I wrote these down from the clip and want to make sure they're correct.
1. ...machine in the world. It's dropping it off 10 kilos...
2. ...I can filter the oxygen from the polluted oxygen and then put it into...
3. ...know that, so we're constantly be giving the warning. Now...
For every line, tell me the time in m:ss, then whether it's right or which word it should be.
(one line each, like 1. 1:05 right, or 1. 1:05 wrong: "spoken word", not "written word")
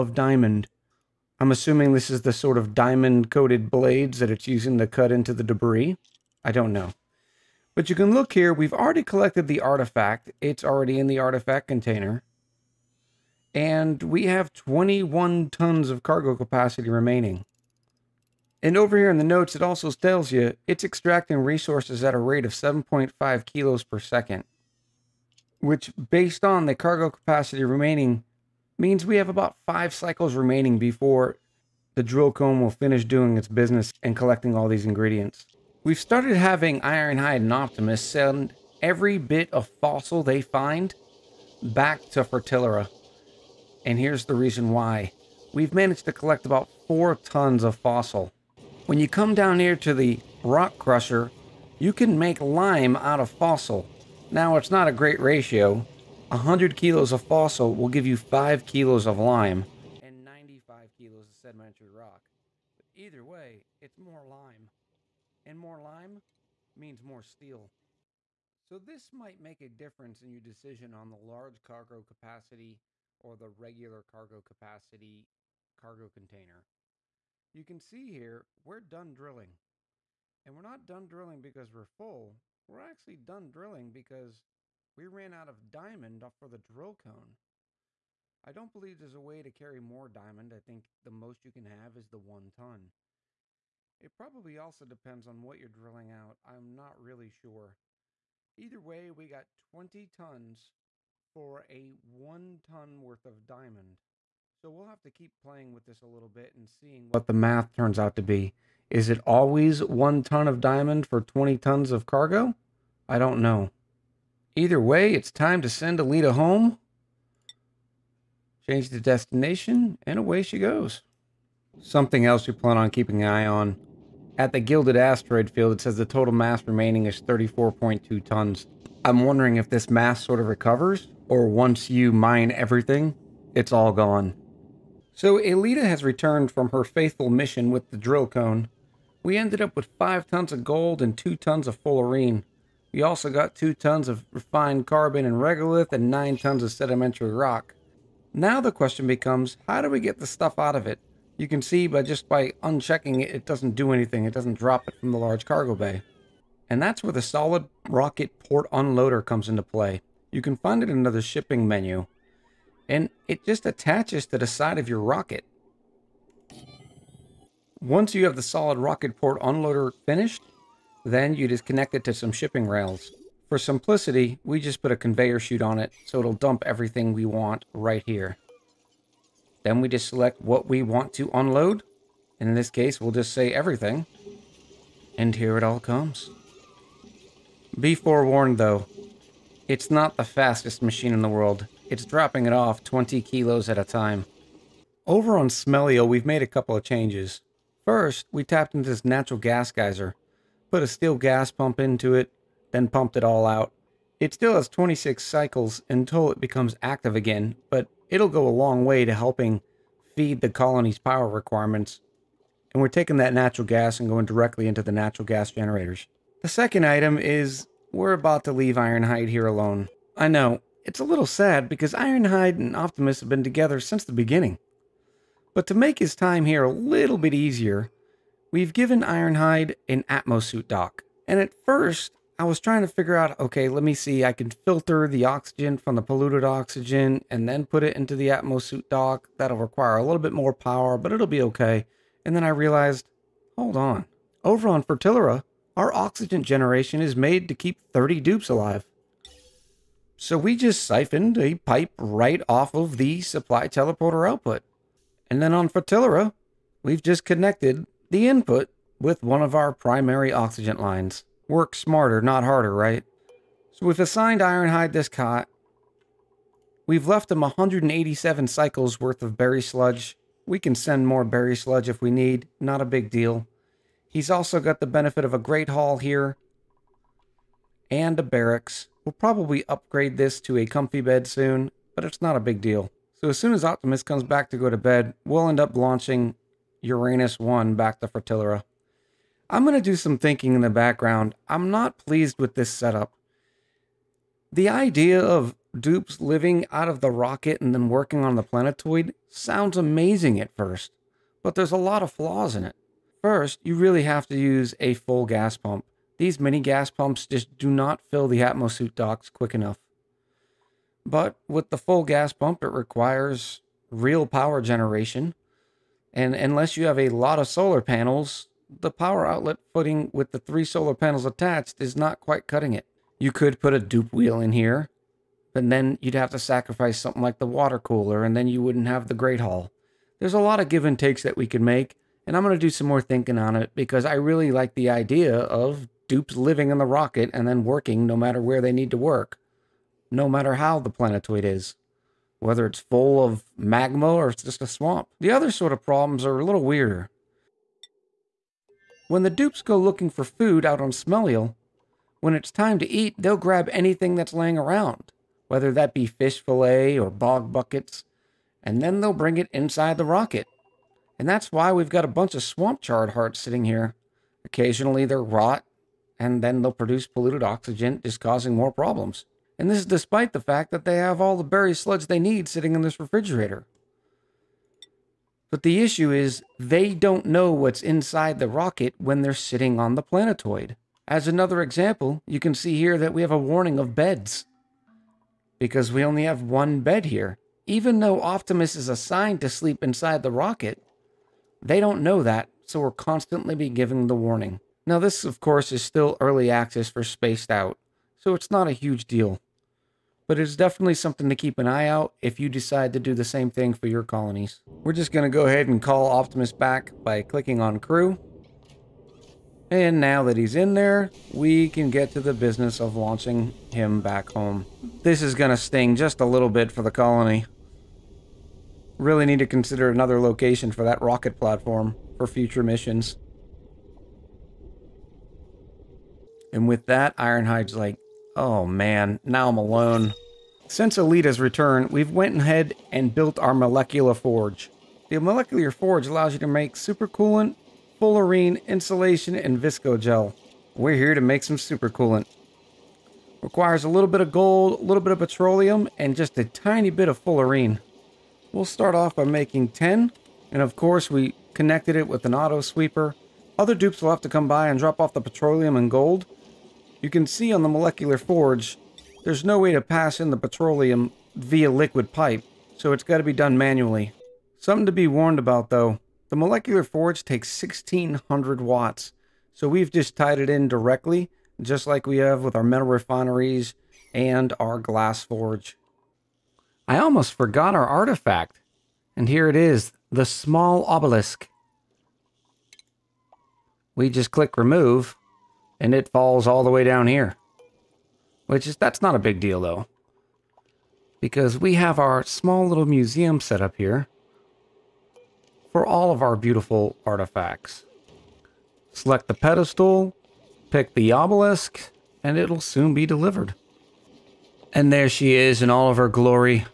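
1. 3:10 wrong: "20", not "10"
2. 3:54 right
3. 6:32 right.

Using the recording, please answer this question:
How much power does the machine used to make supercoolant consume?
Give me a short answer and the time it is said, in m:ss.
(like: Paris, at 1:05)
1600 watts, at 7:47.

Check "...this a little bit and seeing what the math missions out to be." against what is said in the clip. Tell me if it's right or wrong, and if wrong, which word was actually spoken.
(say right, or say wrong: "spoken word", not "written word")
wrong: "turns", not "missions".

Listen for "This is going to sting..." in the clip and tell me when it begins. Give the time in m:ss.
6:55.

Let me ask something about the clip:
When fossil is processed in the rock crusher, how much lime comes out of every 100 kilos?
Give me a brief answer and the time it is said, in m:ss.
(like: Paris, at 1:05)
5 kilos, at 0:58.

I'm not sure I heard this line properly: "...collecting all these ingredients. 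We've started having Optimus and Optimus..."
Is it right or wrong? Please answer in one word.
wrong.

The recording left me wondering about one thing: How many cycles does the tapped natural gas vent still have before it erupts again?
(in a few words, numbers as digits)
26 cycles.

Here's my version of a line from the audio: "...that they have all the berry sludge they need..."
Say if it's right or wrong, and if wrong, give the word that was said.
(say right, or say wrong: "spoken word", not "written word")
right.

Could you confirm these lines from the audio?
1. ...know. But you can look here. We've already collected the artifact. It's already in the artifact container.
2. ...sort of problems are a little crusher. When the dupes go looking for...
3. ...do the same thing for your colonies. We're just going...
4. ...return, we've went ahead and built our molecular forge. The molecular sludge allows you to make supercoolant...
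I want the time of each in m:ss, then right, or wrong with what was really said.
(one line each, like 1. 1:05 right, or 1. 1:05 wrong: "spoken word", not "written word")
1. 0:06 right
2. 5:45 wrong: "weirder", not "crusher"
3. 6:42 right
4. 7:11 wrong: "forge", not "sludge".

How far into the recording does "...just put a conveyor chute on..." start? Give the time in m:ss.
2:54.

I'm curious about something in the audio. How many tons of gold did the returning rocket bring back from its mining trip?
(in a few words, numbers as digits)
5 tons.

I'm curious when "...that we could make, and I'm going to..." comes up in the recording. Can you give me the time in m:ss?
5:31.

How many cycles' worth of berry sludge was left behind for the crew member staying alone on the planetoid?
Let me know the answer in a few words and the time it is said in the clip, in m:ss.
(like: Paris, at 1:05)
187, at 4:27.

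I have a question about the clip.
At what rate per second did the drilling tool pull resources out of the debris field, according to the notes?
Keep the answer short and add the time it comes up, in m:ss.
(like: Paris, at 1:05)
7.5 kilos, at 0:22.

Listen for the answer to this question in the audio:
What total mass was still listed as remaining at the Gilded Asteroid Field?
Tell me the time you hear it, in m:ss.
2:07.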